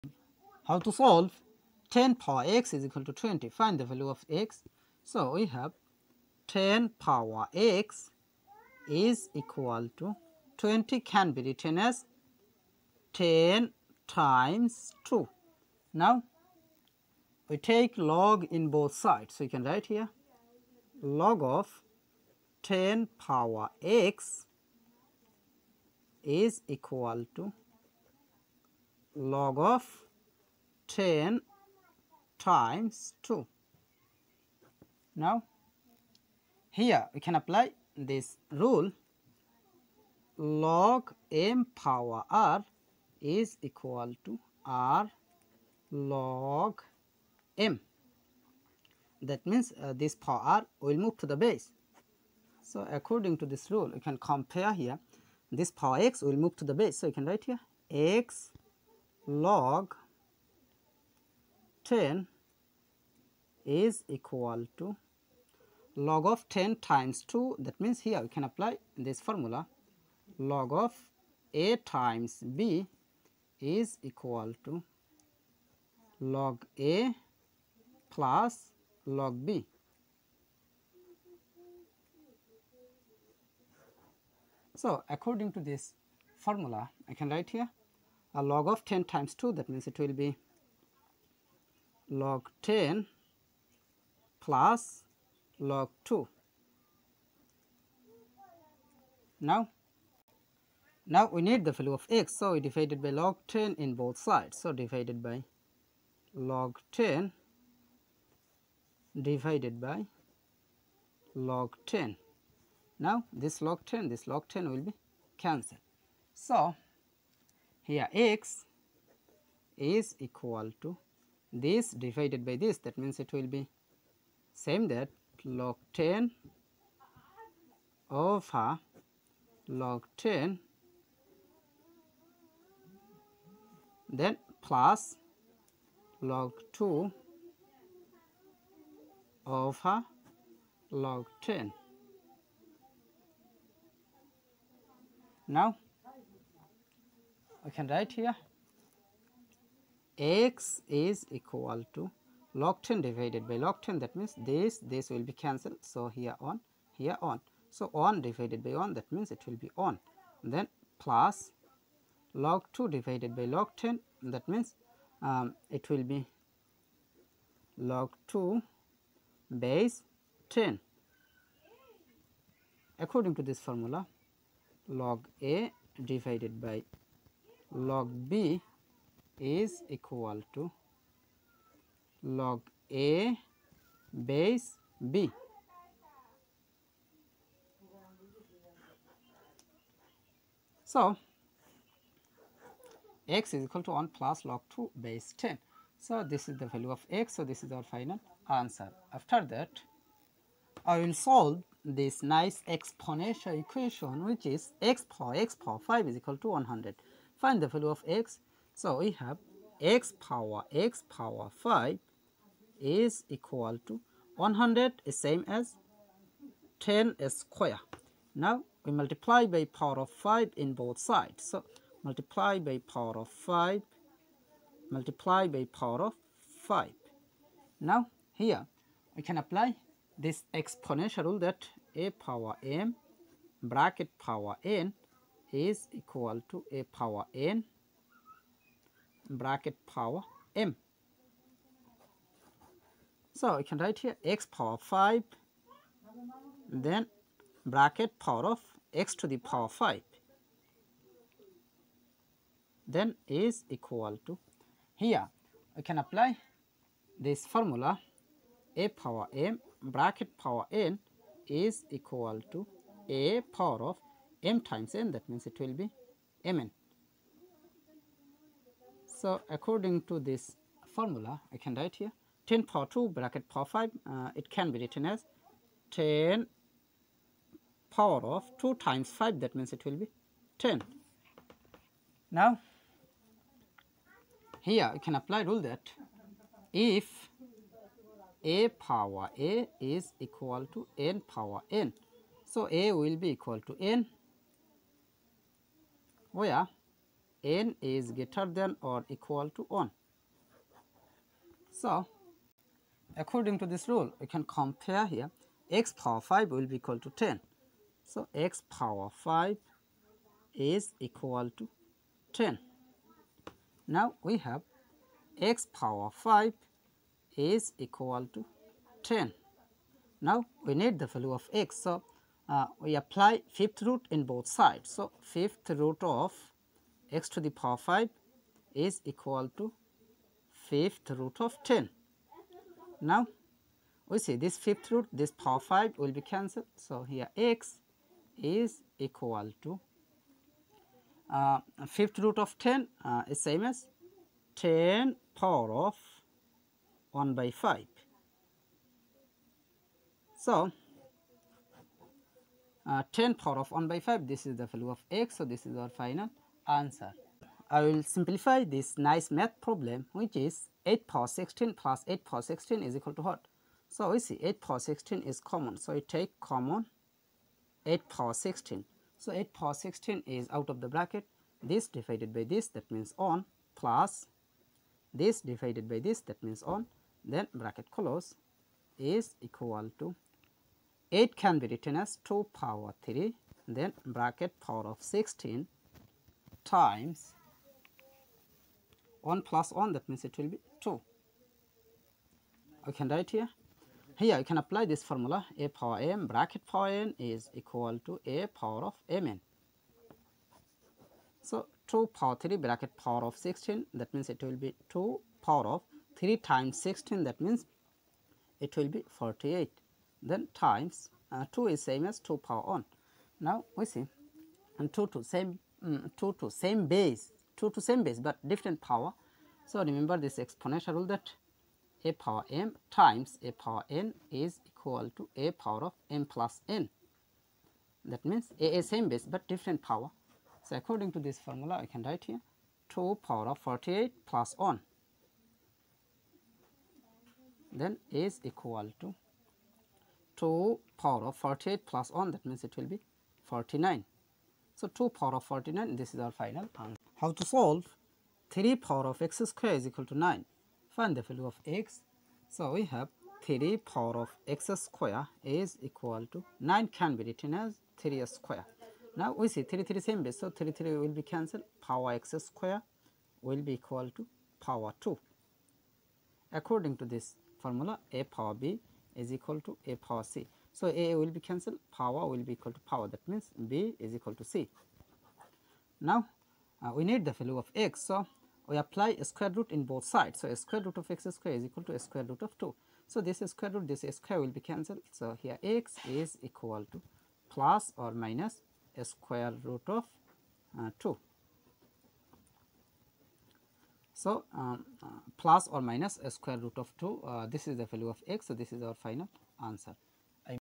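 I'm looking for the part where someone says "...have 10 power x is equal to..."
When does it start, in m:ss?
0:05.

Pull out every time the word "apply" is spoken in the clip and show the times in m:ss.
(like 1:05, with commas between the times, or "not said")
0:37, 1:08, 3:49, 4:15, 4:45, 5:22, 6:34, 7:58.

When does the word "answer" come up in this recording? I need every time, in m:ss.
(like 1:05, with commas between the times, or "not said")
3:18, 5:56, 7:26, 8:19.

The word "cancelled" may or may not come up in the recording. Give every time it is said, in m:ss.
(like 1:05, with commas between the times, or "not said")
1:55, 2:35, 5:36, 7:41, 7:51, 8:04.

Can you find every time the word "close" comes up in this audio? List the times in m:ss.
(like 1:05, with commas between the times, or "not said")
6:17.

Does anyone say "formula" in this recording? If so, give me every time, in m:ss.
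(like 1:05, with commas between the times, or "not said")
1:09, 1:26, 2:53, 4:17, 4:30, 6:35, 7:11, 7:47.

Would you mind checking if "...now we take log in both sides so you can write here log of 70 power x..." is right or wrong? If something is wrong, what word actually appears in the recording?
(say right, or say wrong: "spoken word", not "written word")
wrong: "10", not "70".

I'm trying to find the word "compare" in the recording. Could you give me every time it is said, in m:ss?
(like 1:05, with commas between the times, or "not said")
0:54, 5:04.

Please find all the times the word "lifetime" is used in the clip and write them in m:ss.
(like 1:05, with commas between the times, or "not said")
not said.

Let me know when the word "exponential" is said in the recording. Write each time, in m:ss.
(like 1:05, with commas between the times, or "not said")
3:22, 3:50, 7:00.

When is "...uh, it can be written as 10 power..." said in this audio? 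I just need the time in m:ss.
4:34.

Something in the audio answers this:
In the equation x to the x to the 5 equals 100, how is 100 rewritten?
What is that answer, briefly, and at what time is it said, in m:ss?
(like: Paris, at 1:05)
10 squared, at 3:36.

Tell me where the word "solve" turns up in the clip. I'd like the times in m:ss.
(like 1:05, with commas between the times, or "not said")
0:00, 3:21, 7:27.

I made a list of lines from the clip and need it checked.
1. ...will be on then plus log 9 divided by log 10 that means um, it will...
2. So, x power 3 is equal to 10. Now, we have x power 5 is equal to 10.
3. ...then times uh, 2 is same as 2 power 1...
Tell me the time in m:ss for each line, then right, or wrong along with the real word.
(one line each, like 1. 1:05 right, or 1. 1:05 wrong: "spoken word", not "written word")
1. 2:39 wrong: "2", not "9"
2. 5:08 wrong: "5", not "3"
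3. 6:50 right.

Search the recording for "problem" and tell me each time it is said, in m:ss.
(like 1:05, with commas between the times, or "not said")
5:59.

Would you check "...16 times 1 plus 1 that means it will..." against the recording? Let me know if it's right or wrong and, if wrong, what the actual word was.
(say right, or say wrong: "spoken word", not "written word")
right.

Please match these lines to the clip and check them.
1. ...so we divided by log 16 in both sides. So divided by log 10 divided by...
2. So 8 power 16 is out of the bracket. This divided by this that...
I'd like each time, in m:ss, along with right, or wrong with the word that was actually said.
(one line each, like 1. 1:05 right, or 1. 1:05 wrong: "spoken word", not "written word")
1. 1:42 wrong: "10", not "16"
2. 6:09 right.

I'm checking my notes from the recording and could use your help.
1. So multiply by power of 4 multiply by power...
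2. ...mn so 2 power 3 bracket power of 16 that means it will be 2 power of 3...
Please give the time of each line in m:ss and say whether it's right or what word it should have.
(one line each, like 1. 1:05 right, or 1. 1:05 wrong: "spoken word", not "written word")
1. 3:41 wrong: "5", not "4"
2. 6:39 right.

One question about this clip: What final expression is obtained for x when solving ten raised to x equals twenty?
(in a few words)
1 + log 2 base 10.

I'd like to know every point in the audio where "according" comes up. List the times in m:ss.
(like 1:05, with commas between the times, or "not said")
0:52, 1:25, 2:52, 4:29, 5:03, 7:10, 7:46.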